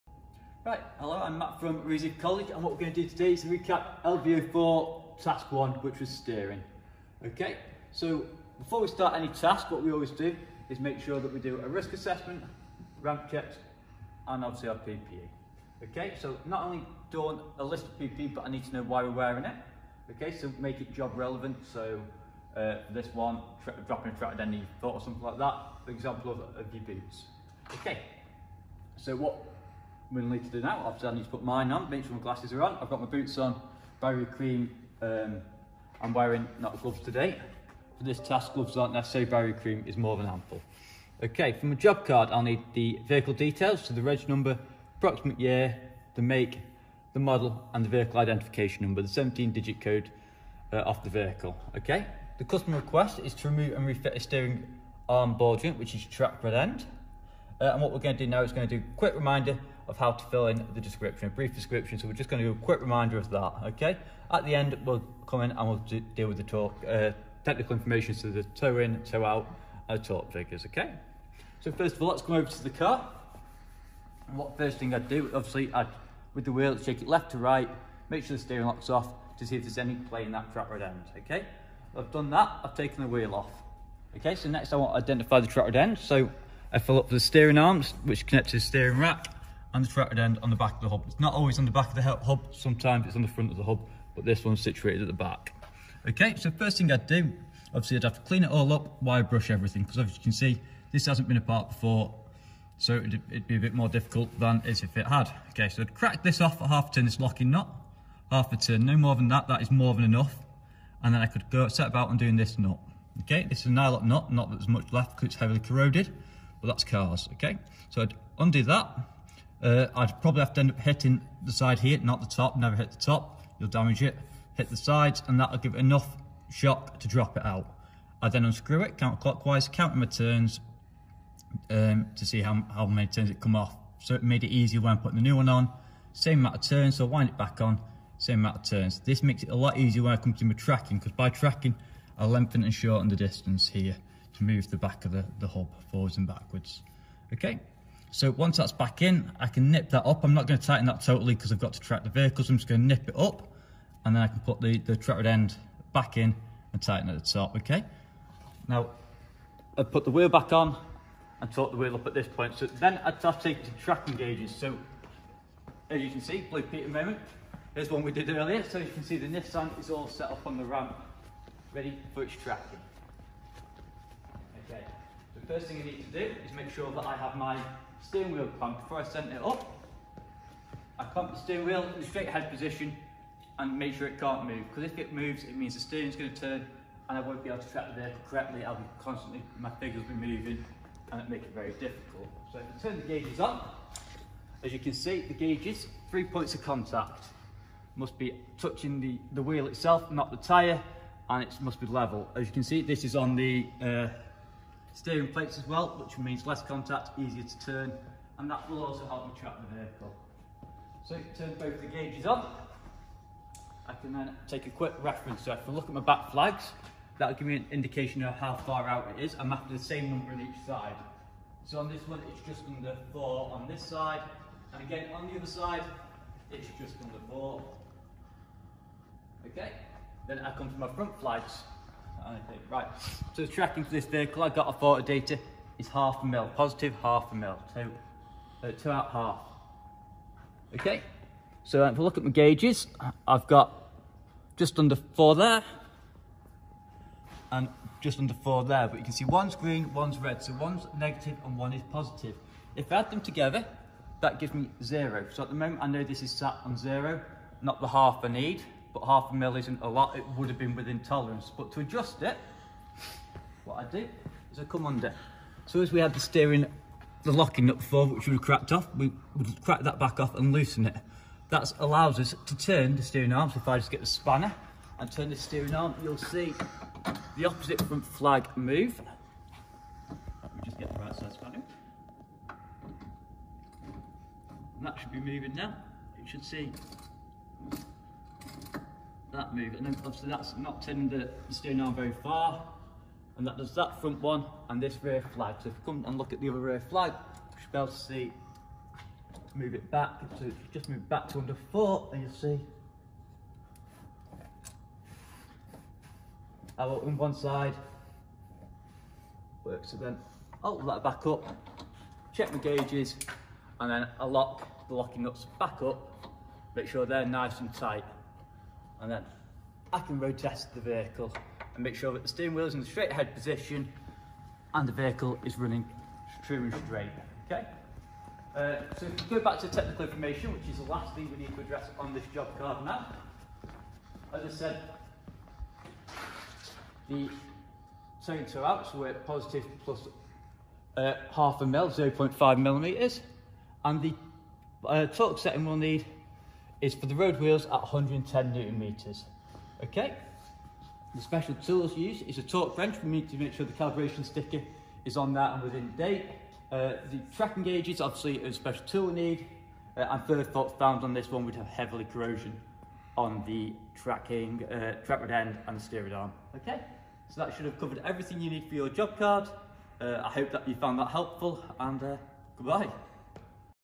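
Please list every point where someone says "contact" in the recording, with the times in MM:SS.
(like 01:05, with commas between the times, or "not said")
03:16, 03:26.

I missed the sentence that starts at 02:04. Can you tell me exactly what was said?
Hit the sides and that'll give it enough shock to drop it out.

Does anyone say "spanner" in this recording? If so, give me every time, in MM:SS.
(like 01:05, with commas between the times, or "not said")
04:34, 04:41.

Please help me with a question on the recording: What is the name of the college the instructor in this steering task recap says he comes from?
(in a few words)
Reezy College.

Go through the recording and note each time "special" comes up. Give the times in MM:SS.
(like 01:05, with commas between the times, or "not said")
05:51, 05:58.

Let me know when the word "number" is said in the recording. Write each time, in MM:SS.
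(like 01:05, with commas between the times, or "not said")
00:44, 00:48, 03:40.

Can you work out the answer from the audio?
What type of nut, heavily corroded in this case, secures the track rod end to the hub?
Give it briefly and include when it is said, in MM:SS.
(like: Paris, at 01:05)
Nylon nut, at 01:53.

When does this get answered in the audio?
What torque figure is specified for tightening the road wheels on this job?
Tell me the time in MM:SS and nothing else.
05:47.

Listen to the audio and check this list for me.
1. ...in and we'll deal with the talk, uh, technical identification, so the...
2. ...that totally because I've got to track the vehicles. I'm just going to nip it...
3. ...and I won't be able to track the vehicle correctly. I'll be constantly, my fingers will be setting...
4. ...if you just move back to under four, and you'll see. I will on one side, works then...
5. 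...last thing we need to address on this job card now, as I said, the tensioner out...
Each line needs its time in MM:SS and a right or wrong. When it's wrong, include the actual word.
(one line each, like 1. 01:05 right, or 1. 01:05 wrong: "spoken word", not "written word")
1. 01:05 wrong: "information", not "identification"
2. 02:30 right
3. 03:07 wrong: "moving", not "setting"
4. 05:00 right
5. 05:30 right.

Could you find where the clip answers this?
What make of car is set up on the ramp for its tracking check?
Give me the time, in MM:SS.
02:49.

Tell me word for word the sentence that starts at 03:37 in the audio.
That'll give me an indication of how far out it is.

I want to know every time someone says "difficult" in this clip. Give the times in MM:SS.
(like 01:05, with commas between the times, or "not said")
01:43, 03:11.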